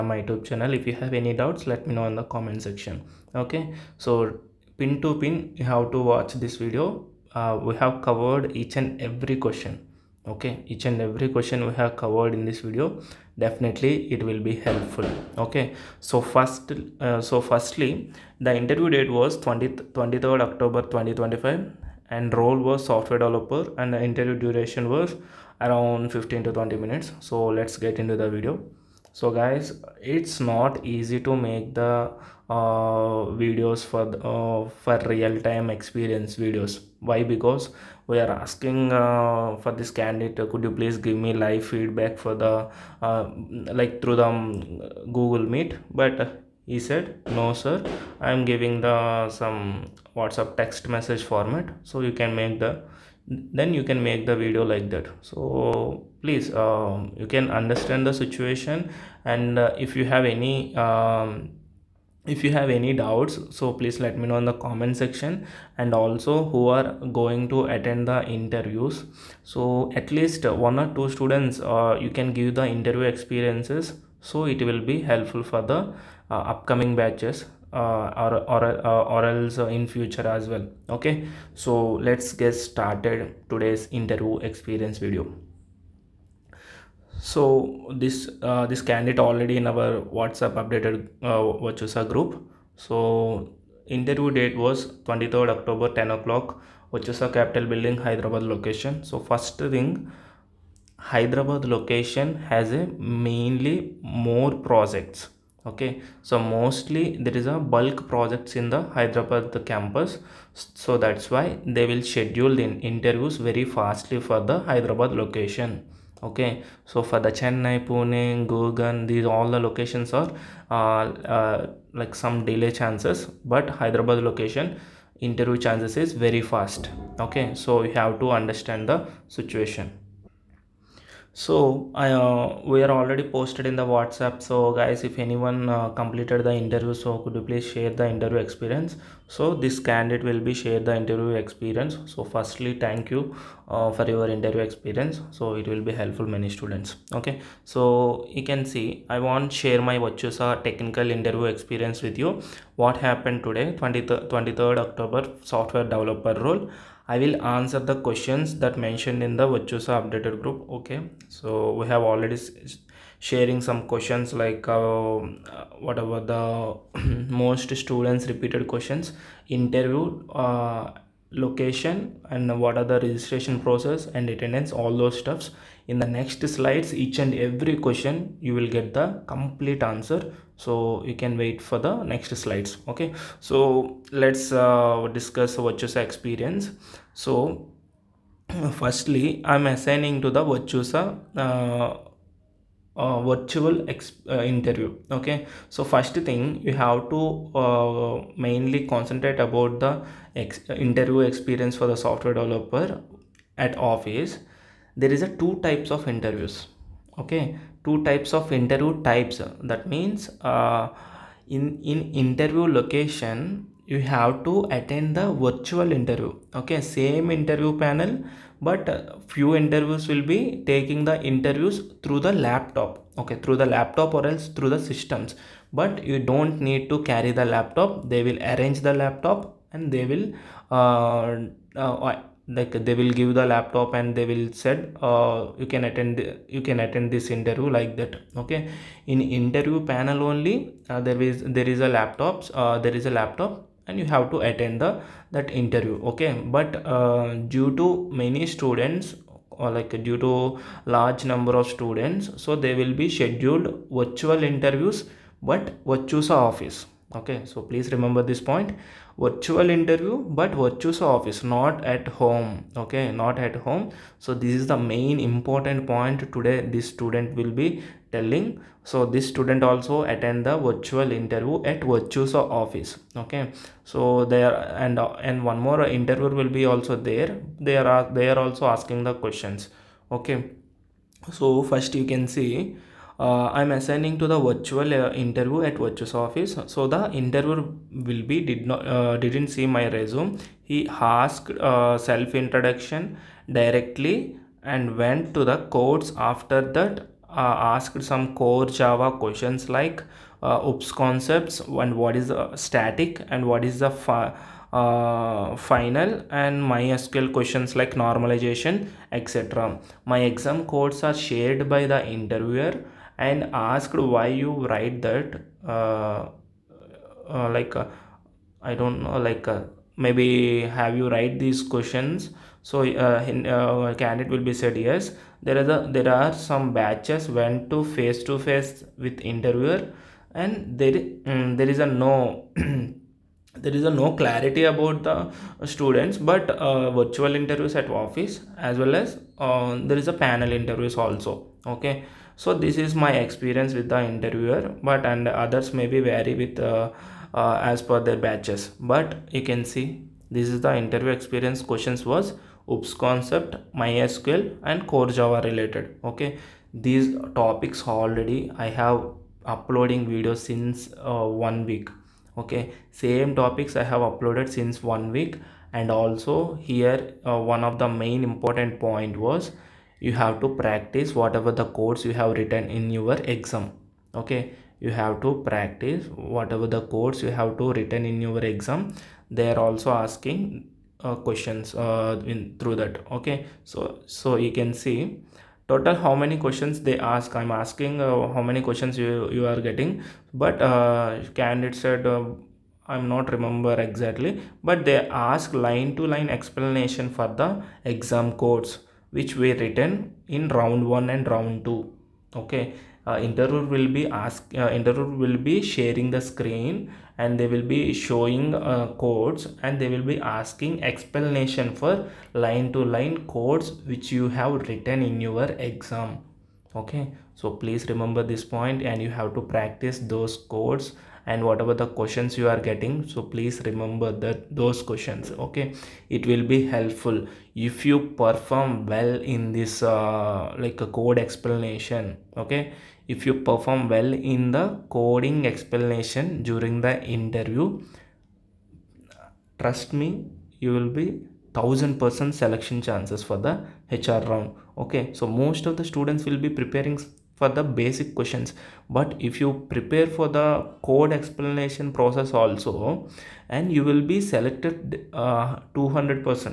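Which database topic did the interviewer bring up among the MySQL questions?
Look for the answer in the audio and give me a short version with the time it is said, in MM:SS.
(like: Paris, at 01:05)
Normalization, at 05:08.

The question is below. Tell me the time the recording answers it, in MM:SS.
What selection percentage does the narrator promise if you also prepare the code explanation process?
07:35.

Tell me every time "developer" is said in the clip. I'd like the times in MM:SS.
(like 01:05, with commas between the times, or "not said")
00:23, 02:35, 03:22.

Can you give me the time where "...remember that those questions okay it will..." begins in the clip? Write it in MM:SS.
07:03.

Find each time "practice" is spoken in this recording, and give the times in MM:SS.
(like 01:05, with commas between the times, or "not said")
06:10, 06:15, 06:59.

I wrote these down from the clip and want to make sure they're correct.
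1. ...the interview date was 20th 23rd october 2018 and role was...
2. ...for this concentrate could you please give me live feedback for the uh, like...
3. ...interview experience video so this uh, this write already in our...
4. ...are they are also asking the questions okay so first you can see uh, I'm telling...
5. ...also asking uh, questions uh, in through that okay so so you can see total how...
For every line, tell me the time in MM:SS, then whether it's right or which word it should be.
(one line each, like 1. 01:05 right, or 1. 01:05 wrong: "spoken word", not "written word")
1. 00:18 wrong: "2025", not "2018"
2. 00:39 wrong: "candidate", not "concentrate"
3. 01:23 wrong: "candidate", not "write"
4. 04:37 wrong: "assigning", not "telling"
5. 06:19 right.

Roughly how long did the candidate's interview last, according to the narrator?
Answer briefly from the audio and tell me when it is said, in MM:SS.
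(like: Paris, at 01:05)
15 to 20 minutes, at 00:26.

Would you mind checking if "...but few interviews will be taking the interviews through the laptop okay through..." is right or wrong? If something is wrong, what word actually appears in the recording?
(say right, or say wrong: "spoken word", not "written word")
right.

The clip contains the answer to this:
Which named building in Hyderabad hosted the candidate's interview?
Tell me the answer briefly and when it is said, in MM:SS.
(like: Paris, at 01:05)
Virtusa Capital Building, at 01:36.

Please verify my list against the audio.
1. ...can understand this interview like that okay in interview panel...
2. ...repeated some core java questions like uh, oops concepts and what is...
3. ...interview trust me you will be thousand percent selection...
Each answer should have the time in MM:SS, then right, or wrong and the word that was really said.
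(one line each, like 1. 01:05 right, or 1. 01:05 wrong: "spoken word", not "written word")
1. 03:56 wrong: "attend", not "understand"
2. 04:57 wrong: "asked", not "repeated"
3. 07:17 right.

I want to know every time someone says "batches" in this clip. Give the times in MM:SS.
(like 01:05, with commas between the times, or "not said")
01:16, 05:26, 05:48.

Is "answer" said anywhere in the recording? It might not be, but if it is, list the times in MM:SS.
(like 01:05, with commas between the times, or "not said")
02:37, 02:59.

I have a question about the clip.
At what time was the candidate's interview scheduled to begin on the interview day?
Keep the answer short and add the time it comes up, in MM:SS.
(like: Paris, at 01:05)
10 o'clock, at 01:36.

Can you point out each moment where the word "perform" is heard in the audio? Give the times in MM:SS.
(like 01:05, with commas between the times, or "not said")
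07:08, 07:13.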